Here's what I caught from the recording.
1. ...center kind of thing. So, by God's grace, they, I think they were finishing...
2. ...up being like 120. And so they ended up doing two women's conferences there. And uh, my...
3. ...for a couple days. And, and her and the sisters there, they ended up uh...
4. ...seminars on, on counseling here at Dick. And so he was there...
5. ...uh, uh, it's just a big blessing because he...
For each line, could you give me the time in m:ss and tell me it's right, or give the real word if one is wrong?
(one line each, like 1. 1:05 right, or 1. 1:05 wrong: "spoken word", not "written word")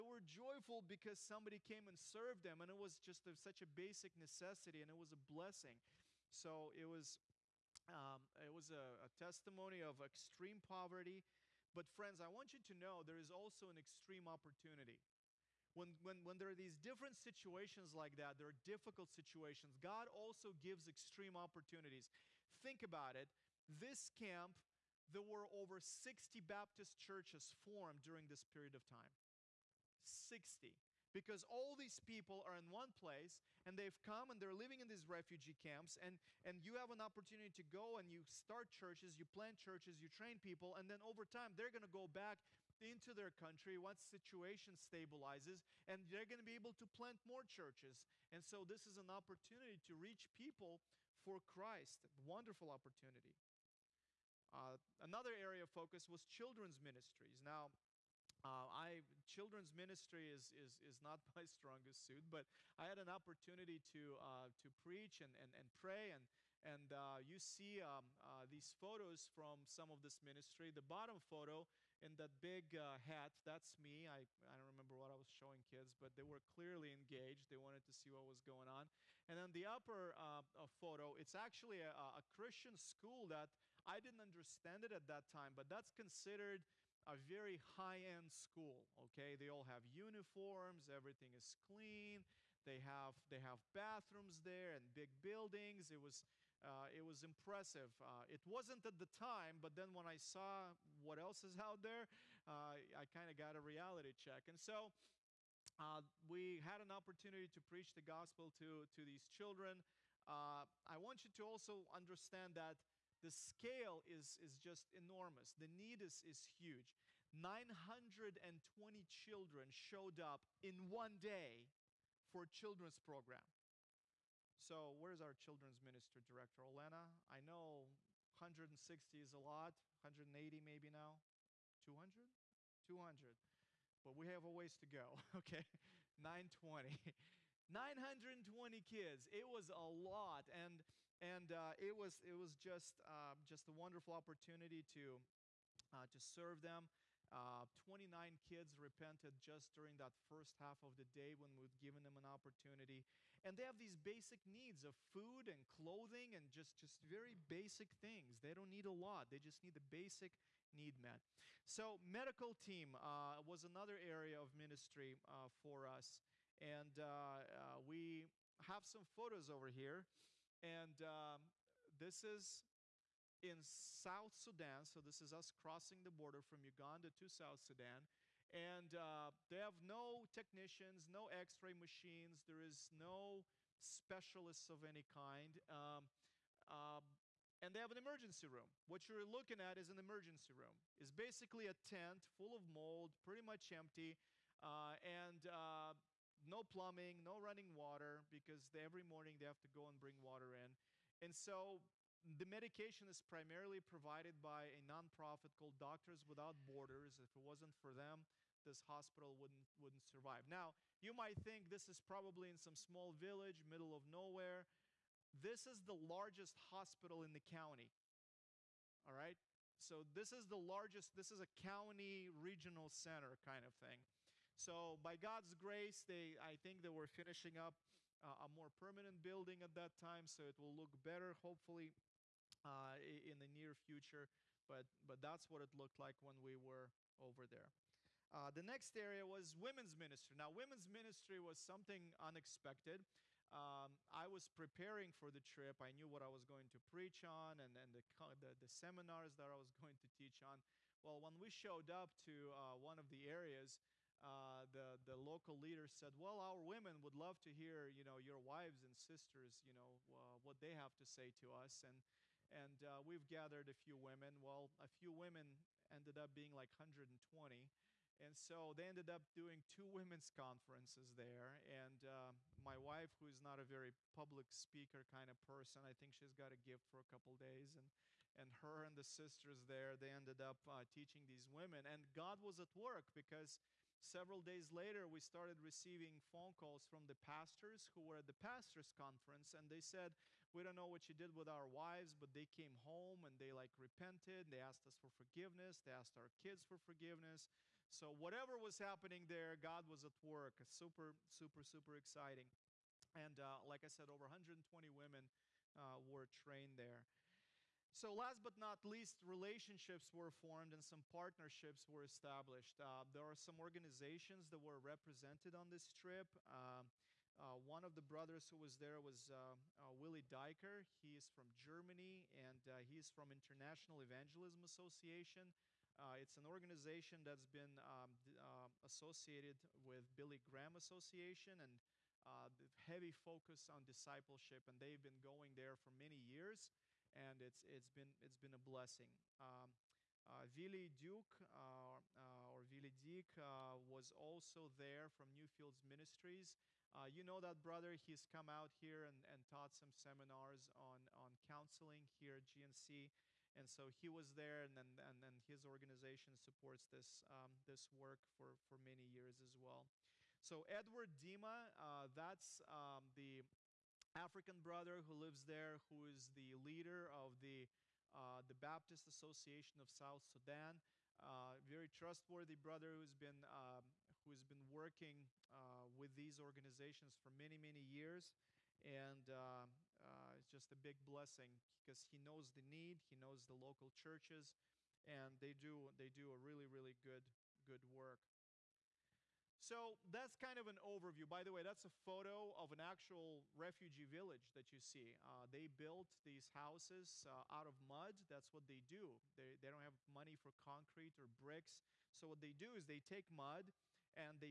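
1. 3:42 right
2. 4:26 right
3. 4:36 right
4. 5:49 wrong: "GNC", not "Dick"
5. 6:19 right.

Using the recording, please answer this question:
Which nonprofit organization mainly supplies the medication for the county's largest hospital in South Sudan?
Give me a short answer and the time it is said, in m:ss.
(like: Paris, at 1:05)
Doctors Without Borders, at 3:25.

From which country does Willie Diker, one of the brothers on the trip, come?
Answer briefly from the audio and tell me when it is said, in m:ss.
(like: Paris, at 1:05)
Germany, at 5:21.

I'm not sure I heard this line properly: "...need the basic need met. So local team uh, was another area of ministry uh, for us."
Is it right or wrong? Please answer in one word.
wrong.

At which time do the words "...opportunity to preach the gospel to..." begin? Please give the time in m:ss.
1:46.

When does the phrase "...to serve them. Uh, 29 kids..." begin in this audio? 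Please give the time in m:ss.
2:26.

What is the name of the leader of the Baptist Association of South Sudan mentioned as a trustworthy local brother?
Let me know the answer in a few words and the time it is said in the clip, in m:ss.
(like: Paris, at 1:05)
Edward Dima, at 6:00.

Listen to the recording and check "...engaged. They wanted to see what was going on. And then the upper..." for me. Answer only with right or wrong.
right.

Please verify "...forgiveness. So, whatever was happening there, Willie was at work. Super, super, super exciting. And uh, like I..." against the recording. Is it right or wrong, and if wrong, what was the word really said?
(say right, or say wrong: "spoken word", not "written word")
wrong: "God", not "Willie".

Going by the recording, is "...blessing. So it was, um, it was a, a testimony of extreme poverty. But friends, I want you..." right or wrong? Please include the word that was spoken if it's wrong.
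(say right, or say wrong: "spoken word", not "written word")
right.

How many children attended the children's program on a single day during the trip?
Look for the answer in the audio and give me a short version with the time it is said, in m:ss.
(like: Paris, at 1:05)
920, at 1:57.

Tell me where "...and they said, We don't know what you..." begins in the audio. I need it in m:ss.
4:49.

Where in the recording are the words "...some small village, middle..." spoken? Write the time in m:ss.
3:32.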